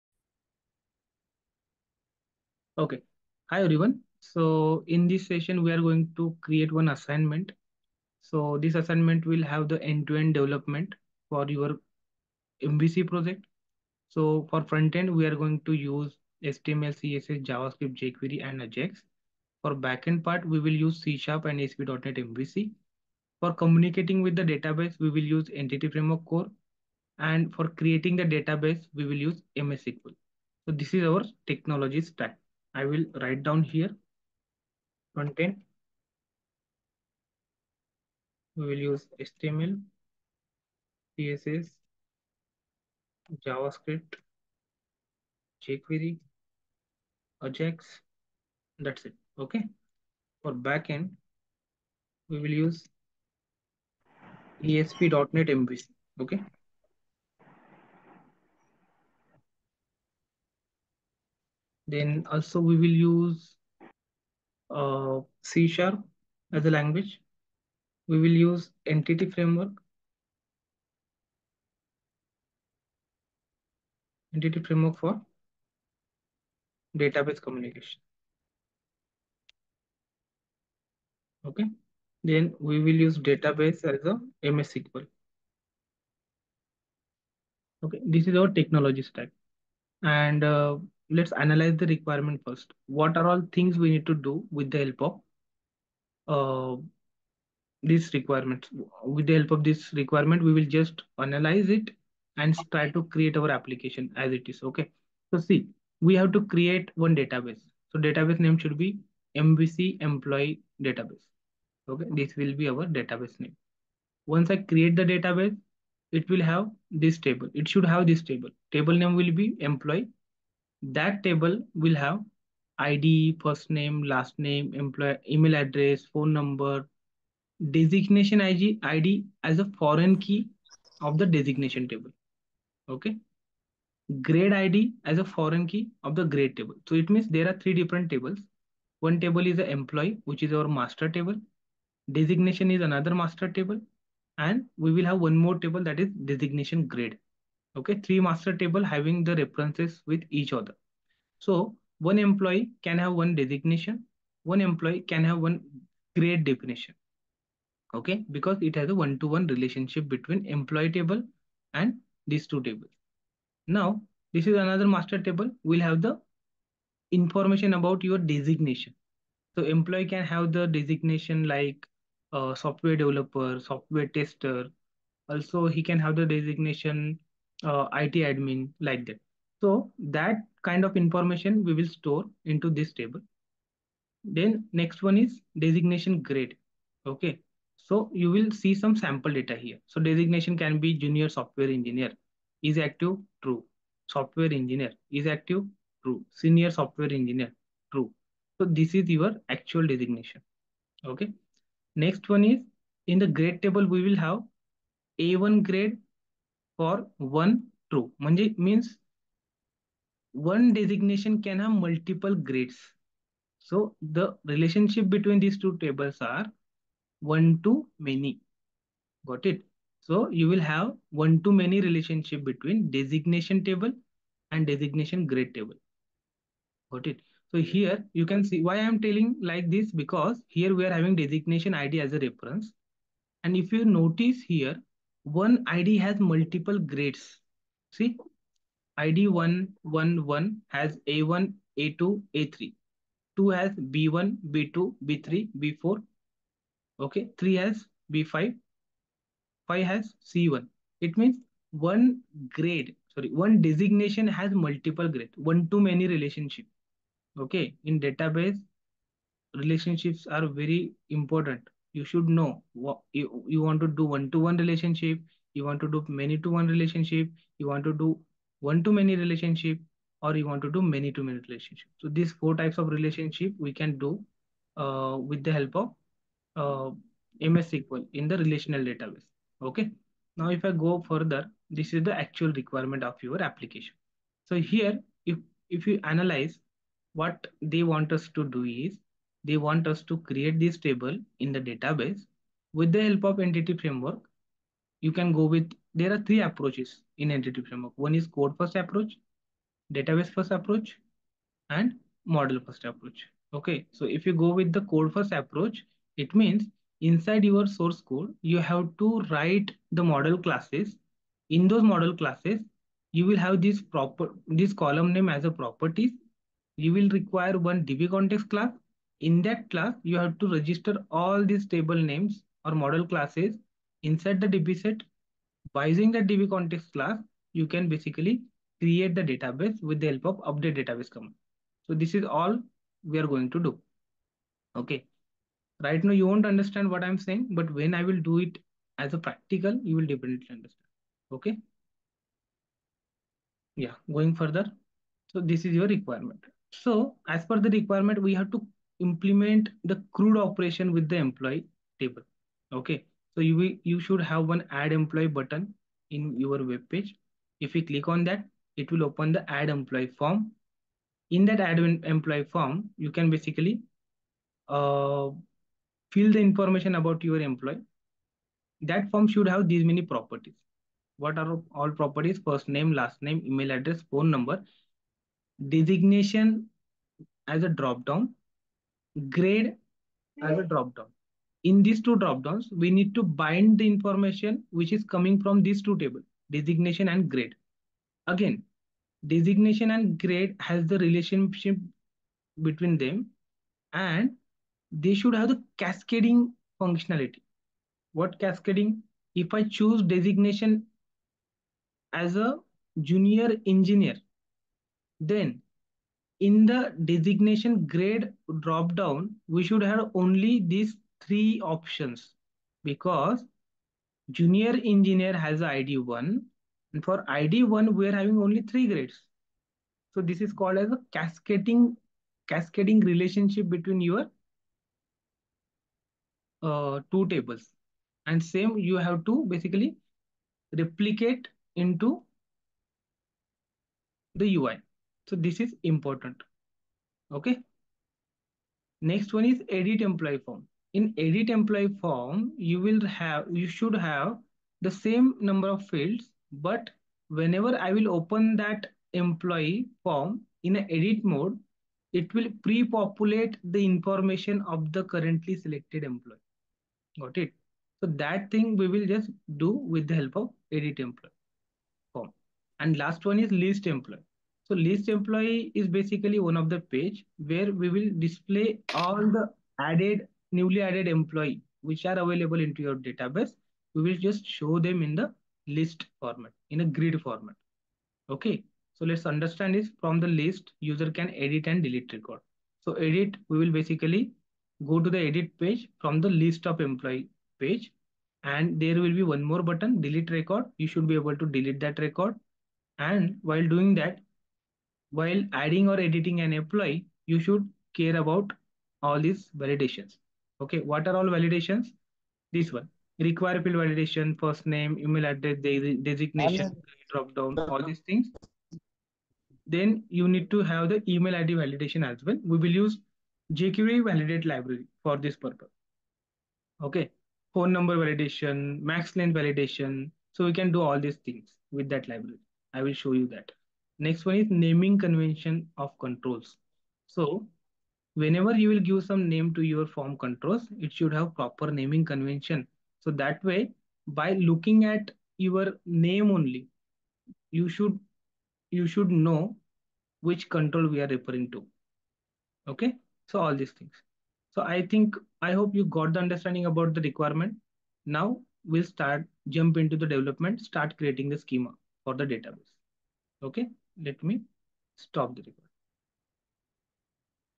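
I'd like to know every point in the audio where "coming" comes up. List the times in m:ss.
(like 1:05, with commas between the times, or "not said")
6:25.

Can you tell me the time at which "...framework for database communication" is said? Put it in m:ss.
1:14.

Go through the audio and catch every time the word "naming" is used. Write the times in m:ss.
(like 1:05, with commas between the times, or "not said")
8:44, 8:51.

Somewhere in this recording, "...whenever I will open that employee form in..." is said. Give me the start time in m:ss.
7:27.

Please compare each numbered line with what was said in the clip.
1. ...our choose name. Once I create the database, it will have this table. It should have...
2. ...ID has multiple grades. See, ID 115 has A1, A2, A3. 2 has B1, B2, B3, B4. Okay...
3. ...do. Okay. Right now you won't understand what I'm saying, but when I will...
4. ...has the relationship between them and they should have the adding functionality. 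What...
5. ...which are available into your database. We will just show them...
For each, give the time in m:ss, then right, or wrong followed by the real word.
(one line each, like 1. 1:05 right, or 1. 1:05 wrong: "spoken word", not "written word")
1. 1:52 wrong: "database", not "choose"
2. 3:55 wrong: "111", not "115"
3. 5:33 right
4. 6:30 wrong: "cascading", not "adding"
5. 7:51 right.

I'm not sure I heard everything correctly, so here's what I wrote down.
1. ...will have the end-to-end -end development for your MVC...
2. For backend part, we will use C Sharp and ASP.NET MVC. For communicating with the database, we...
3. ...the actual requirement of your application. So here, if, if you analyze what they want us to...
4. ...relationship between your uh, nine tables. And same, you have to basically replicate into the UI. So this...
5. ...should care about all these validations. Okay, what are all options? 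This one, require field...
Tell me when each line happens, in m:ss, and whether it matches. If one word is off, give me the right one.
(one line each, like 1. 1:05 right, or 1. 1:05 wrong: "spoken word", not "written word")
1. 0:09 right
2. 0:19 right
3. 4:42 right
4. 7:03 wrong: "two", not "nine"
5. 8:17 wrong: "validations", not "options".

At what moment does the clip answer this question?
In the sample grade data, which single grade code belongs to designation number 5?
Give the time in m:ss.
4:10.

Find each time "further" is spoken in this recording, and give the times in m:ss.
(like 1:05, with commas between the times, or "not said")
4:41, 5:44.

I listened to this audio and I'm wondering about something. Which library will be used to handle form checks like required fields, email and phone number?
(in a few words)
jQuery validate.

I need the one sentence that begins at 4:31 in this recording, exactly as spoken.
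So these four types of relationship we can do uh, with the help of uh, MS SQL in the relational database.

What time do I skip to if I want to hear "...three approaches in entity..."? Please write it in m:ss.
4:56.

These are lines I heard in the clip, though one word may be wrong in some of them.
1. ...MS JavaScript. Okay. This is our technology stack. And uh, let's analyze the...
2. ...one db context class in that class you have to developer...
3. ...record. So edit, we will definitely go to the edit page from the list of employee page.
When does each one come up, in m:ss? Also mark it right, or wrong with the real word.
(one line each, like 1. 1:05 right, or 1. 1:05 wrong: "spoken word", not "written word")
1. 1:24 wrong: "SQL", not "JavaScript"
2. 5:17 wrong: "register", not "developer"
3. 8:02 wrong: "basically", not "definitely".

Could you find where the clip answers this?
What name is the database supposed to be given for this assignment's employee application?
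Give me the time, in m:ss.
1:49.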